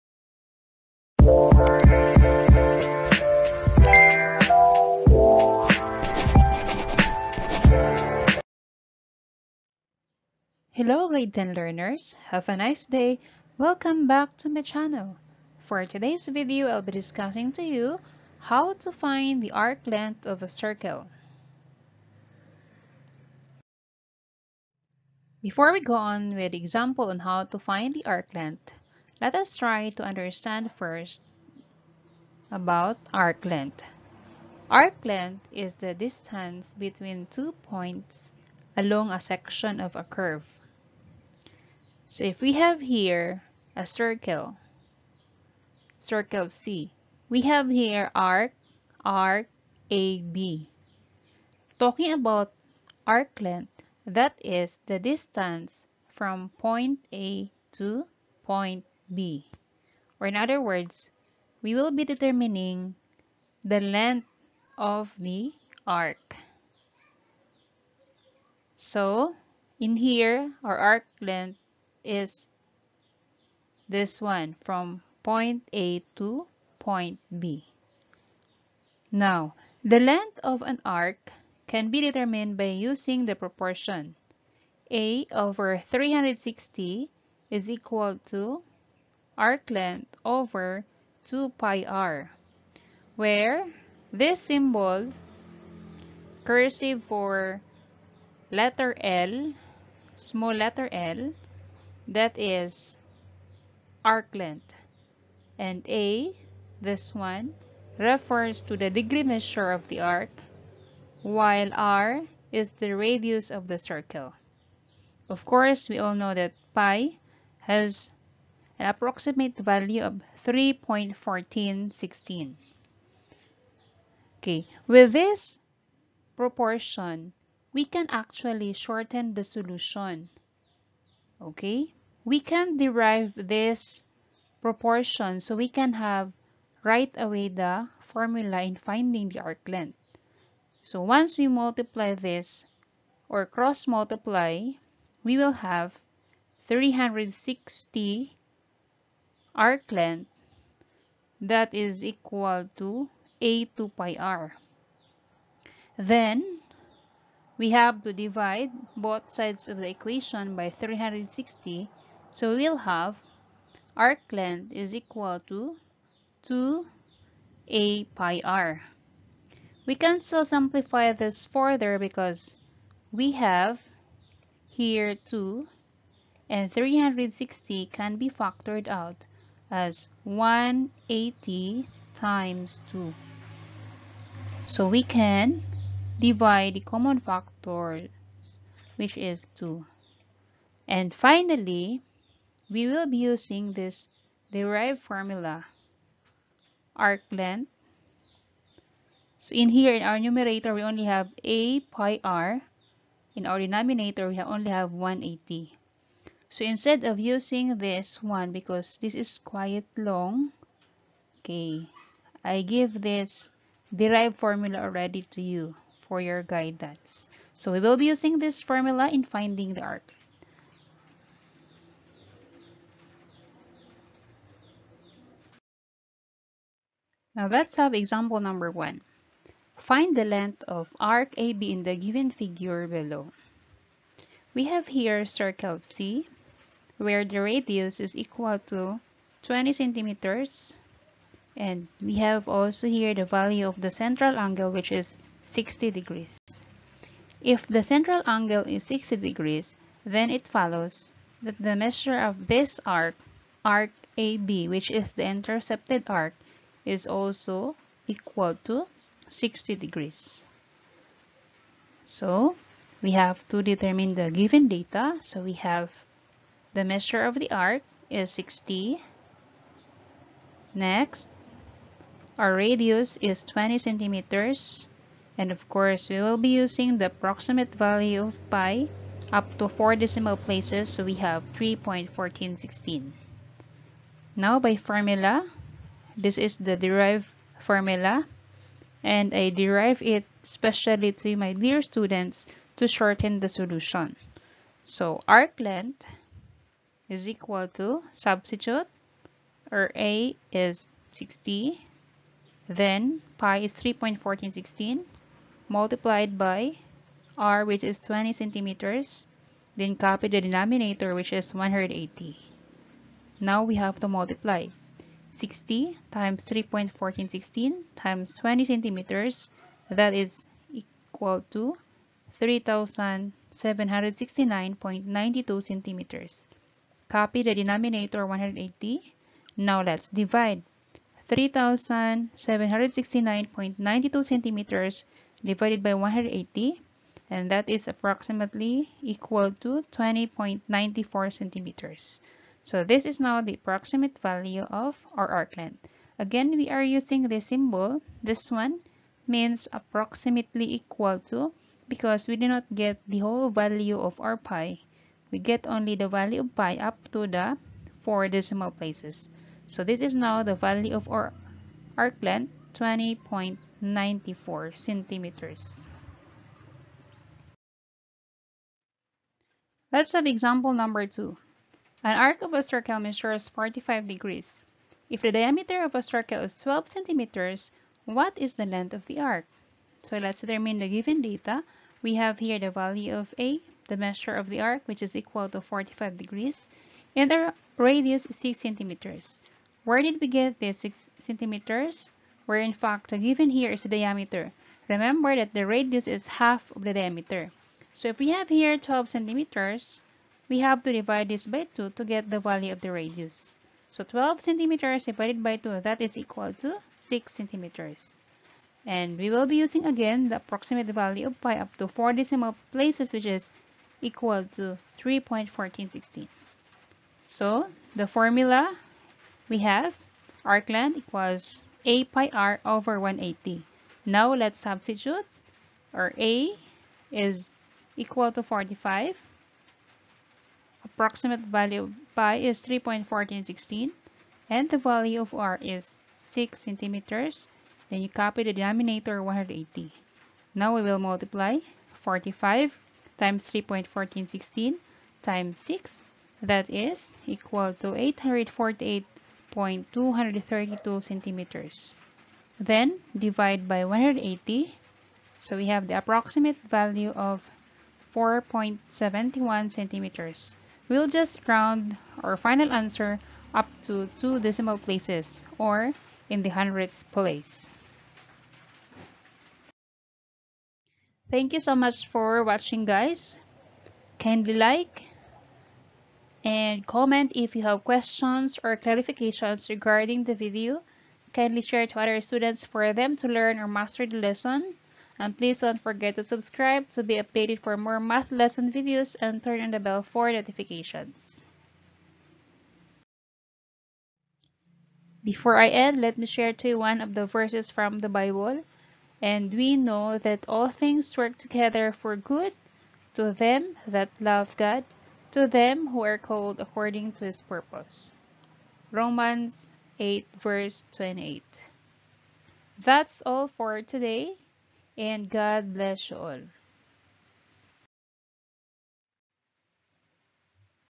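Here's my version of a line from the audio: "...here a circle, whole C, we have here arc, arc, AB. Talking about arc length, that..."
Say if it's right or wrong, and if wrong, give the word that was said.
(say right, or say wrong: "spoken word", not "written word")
wrong: "circle", not "whole".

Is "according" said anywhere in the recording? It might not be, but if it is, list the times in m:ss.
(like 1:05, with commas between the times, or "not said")
8:26.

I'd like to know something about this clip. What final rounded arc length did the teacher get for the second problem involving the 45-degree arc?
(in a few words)
4.71 centimeters.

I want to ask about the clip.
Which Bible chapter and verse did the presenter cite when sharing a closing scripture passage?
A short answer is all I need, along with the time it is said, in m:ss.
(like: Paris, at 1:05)
Romans 8:28, at 8:28.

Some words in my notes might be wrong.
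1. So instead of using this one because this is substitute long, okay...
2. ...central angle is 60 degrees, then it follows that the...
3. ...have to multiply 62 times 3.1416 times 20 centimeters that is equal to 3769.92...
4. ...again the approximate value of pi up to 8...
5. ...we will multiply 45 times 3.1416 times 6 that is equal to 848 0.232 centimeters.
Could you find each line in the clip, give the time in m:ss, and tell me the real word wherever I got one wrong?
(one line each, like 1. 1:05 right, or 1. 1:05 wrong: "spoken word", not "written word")
1. 3:26 wrong: "quite", not "substitute"
2. 4:07 right
3. 5:13 wrong: "60", not "62"
4. 6:49 wrong: "4", not "8"
5. 7:20 right.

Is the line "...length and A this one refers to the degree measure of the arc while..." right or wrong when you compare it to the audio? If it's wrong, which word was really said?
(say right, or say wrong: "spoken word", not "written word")
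right.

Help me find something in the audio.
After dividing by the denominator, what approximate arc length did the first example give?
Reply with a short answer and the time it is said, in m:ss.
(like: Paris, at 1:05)
20.94 centimeters, at 5:39.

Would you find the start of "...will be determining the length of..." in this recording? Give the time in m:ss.
1:01.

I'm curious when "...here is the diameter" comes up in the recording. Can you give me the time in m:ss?
6:33.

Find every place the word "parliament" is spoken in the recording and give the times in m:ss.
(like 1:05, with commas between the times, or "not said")
not said.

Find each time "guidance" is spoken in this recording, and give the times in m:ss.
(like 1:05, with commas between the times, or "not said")
3:36.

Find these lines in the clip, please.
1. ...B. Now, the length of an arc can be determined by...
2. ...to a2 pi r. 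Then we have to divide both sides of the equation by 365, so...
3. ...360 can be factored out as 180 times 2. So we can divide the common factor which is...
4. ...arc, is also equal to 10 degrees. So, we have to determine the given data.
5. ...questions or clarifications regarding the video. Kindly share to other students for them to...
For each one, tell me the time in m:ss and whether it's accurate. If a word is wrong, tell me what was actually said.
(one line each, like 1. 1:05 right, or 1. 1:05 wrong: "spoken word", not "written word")
1. 1:17 right
2. 2:32 wrong: "360", not "365"
3. 2:56 right
4. 4:16 wrong: "60", not "10"
5. 7:57 right.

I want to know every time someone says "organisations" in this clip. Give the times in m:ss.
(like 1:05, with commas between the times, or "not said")
not said.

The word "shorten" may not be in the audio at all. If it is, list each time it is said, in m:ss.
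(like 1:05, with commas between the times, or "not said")
2:08, 4:52.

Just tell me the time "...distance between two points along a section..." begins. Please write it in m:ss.
0:35.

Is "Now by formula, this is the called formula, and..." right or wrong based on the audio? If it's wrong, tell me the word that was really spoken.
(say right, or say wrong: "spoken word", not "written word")
wrong: "derived", not "called".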